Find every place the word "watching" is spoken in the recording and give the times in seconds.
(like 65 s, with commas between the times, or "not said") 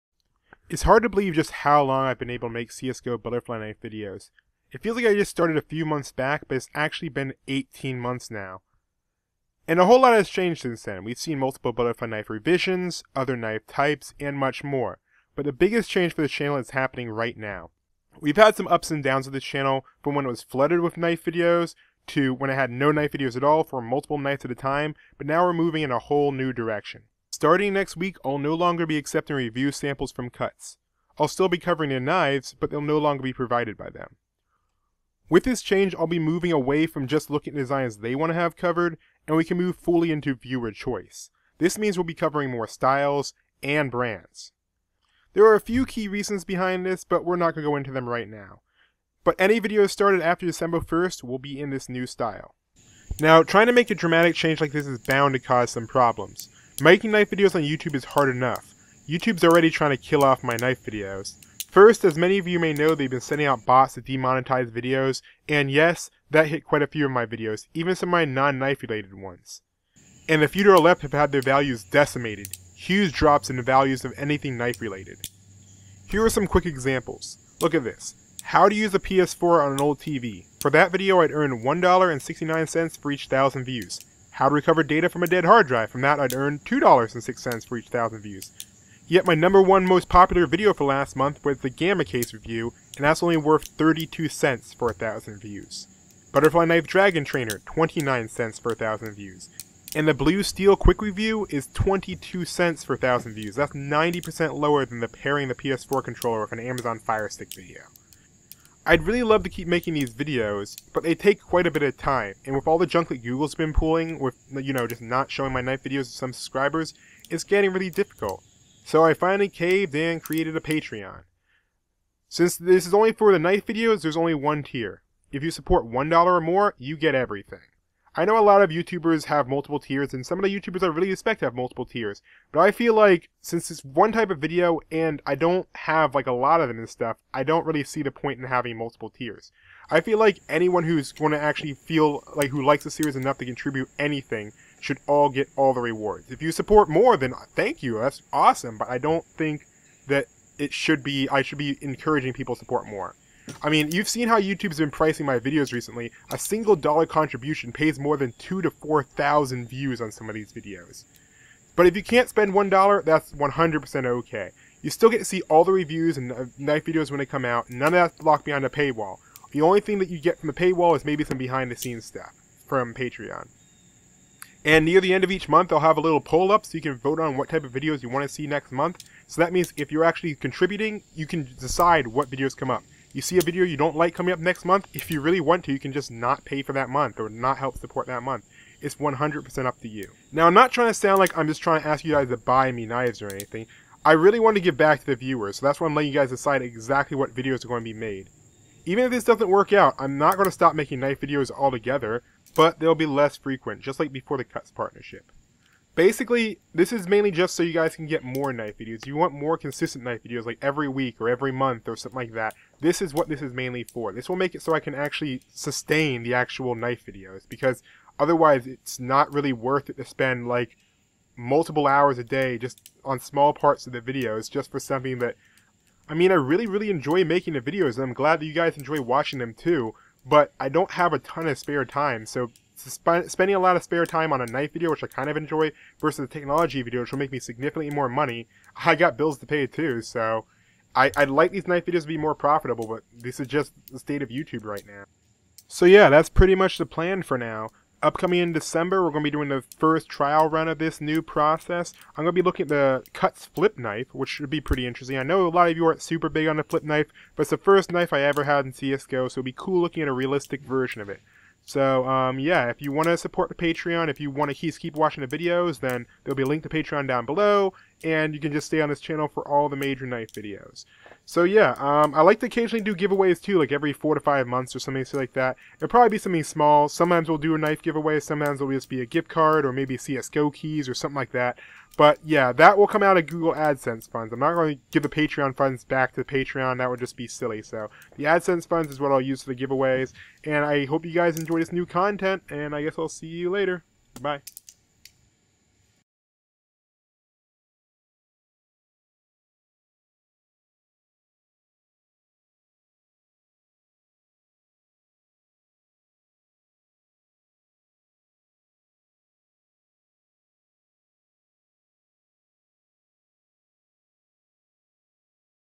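229 s, 264 s.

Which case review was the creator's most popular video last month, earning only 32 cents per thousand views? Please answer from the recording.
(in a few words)
Gamma Case.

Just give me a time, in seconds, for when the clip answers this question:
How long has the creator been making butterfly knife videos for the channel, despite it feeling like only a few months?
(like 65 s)
7 s.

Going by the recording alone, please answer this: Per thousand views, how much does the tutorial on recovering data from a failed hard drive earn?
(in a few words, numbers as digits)
$2.06.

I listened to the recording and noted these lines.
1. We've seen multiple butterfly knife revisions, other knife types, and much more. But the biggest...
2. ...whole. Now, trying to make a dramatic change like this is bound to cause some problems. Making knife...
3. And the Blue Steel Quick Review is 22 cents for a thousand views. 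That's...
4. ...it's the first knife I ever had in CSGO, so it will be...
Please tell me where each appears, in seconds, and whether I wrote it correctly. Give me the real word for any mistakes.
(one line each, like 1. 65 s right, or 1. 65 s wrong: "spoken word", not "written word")
1. 11 s right
2. 52 s wrong: "style", not "whole"
3. 99 s right
4. 257 s right.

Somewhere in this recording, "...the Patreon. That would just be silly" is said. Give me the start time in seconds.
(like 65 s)
286 s.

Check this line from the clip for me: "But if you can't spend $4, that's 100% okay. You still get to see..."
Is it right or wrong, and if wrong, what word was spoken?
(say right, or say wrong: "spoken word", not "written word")
wrong: "1", not "4".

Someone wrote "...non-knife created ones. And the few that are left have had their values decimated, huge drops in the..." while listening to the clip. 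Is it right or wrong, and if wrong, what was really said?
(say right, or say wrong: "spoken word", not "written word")
wrong: "related", not "created".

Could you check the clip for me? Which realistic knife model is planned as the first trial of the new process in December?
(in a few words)
Cuts Flip Knife.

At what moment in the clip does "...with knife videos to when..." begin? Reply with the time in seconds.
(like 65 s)
20 s.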